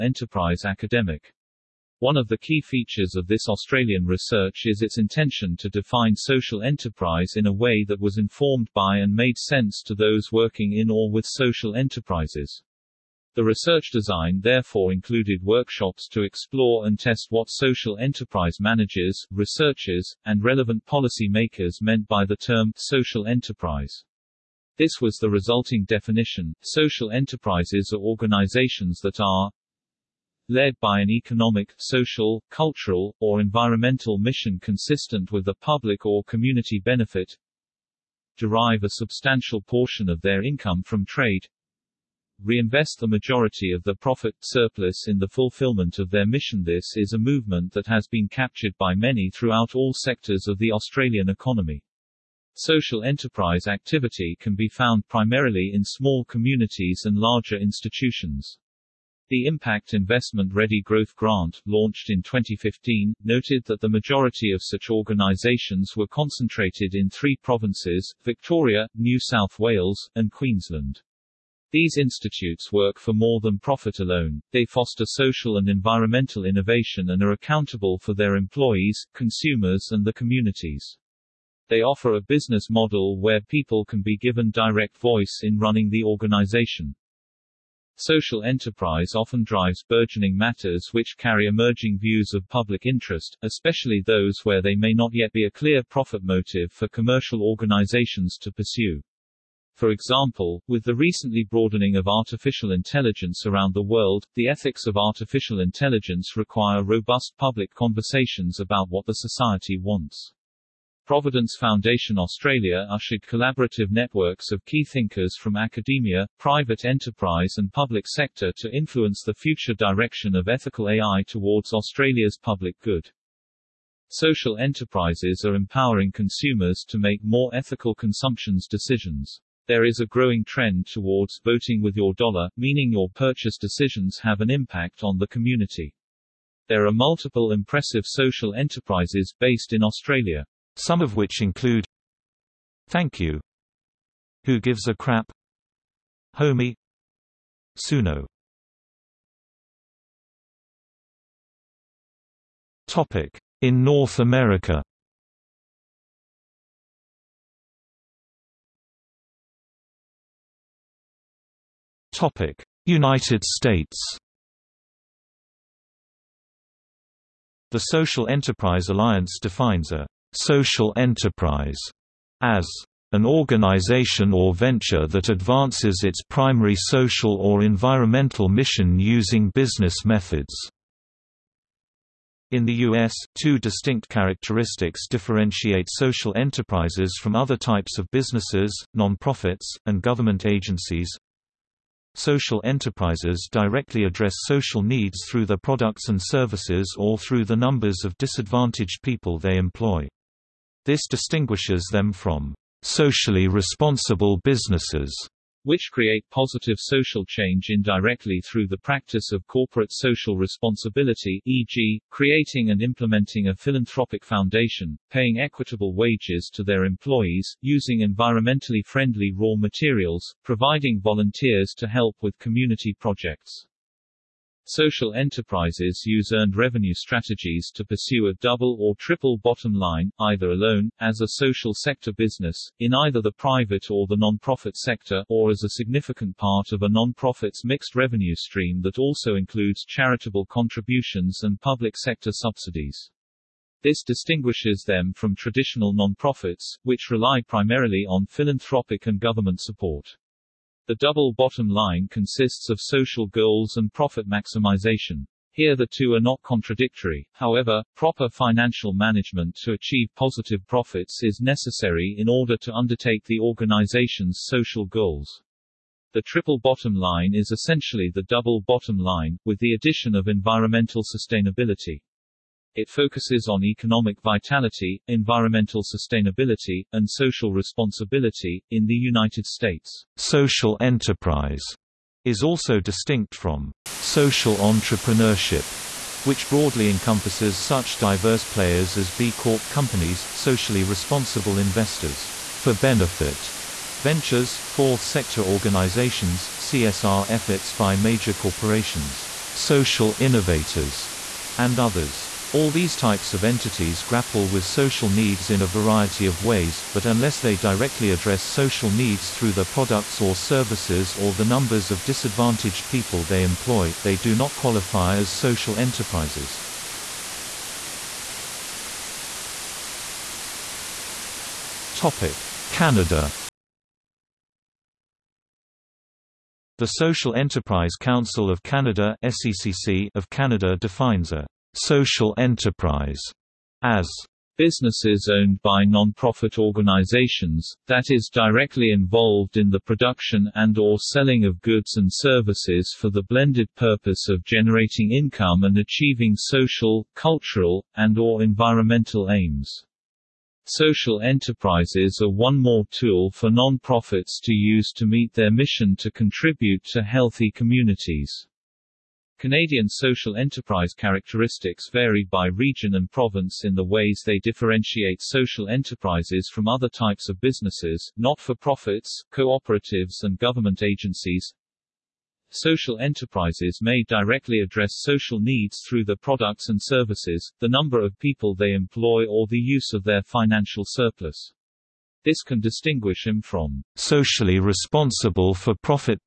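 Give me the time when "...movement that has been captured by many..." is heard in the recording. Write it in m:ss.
0:47.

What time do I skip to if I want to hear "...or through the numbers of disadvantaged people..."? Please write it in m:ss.
3:16.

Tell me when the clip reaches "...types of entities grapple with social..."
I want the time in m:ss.
5:02.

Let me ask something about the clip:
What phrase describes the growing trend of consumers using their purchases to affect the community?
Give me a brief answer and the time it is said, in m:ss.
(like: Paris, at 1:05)
Voting with your dollar, at 2:11.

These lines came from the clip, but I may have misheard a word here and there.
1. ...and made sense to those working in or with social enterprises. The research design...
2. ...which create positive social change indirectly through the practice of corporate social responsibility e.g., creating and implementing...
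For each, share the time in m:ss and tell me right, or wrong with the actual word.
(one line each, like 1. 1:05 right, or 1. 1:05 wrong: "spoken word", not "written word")
1. 0:08 right
2. 3:25 right.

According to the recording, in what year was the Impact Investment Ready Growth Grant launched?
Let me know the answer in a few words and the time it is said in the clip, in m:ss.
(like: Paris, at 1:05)
2015, at 1:02.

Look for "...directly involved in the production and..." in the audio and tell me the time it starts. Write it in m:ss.
5:38.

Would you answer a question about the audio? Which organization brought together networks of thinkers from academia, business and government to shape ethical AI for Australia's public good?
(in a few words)
Providence Foundation Australia.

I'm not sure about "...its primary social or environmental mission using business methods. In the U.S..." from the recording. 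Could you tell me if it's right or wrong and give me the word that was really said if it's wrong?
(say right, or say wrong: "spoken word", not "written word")
right.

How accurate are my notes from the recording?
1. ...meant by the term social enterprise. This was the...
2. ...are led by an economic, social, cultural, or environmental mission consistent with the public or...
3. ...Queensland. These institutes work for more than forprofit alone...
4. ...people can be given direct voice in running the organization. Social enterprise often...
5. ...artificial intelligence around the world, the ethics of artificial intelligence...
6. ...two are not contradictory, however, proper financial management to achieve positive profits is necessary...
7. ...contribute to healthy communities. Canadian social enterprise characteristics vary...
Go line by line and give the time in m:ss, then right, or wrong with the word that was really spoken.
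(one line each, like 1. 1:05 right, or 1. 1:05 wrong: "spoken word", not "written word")
1. 0:21 right
2. 0:29 right
3. 1:10 wrong: "profit", not "forprofit"
4. 1:23 right
5. 1:42 right
6. 4:15 right
7. 5:56 right.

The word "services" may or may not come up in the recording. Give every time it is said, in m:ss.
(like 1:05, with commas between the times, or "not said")
3:16, 5:10, 5:42, 6:16.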